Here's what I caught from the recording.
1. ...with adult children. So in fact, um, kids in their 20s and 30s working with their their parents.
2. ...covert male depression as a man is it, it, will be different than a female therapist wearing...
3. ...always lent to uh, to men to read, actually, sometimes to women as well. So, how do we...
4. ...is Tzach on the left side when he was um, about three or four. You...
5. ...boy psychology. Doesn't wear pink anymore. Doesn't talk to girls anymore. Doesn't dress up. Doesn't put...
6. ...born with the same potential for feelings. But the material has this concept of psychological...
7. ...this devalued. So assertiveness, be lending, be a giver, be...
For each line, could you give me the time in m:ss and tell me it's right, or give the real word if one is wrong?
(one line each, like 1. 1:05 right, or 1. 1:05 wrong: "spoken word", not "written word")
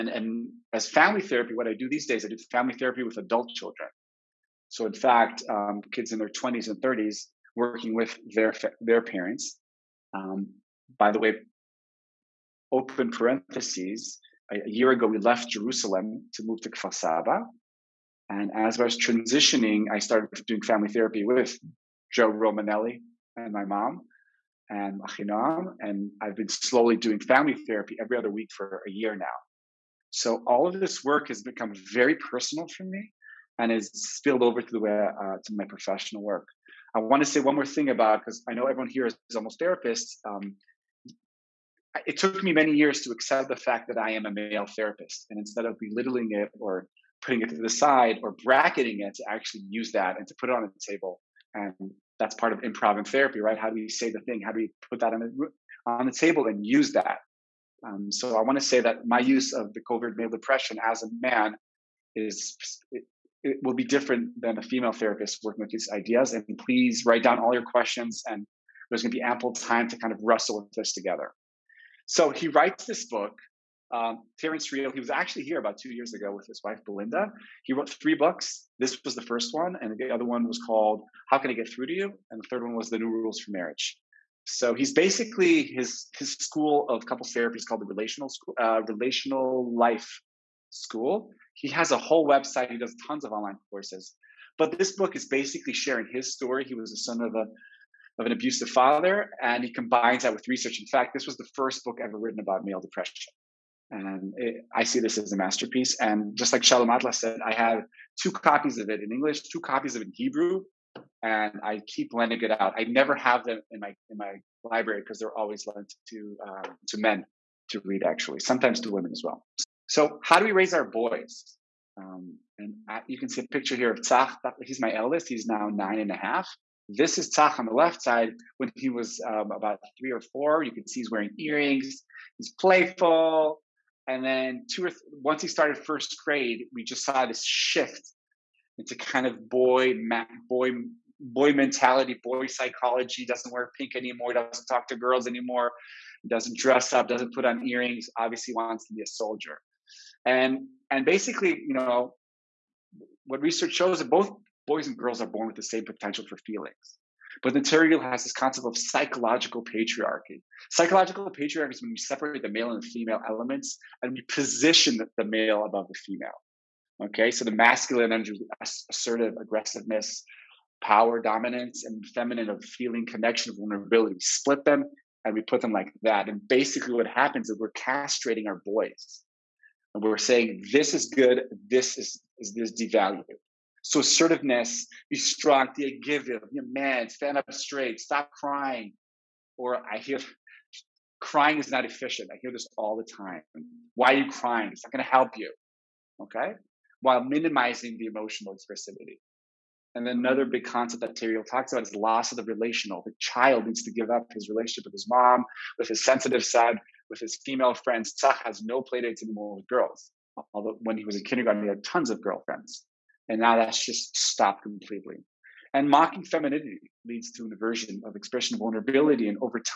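1. 0:03 right
2. 0:59 wrong: "working", not "wearing"
3. 1:55 right
4. 2:07 right
5. 2:22 right
6. 2:35 right
7. 3:02 wrong: "strong", not "lending".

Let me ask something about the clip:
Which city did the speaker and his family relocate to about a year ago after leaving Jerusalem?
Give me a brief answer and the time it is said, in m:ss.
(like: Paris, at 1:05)
Kfar Saba, at 0:16.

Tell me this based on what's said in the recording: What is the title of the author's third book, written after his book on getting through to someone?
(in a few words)
The New Rules for Marriage.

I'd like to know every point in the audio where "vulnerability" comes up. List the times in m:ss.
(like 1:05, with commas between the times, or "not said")
2:53, 3:38.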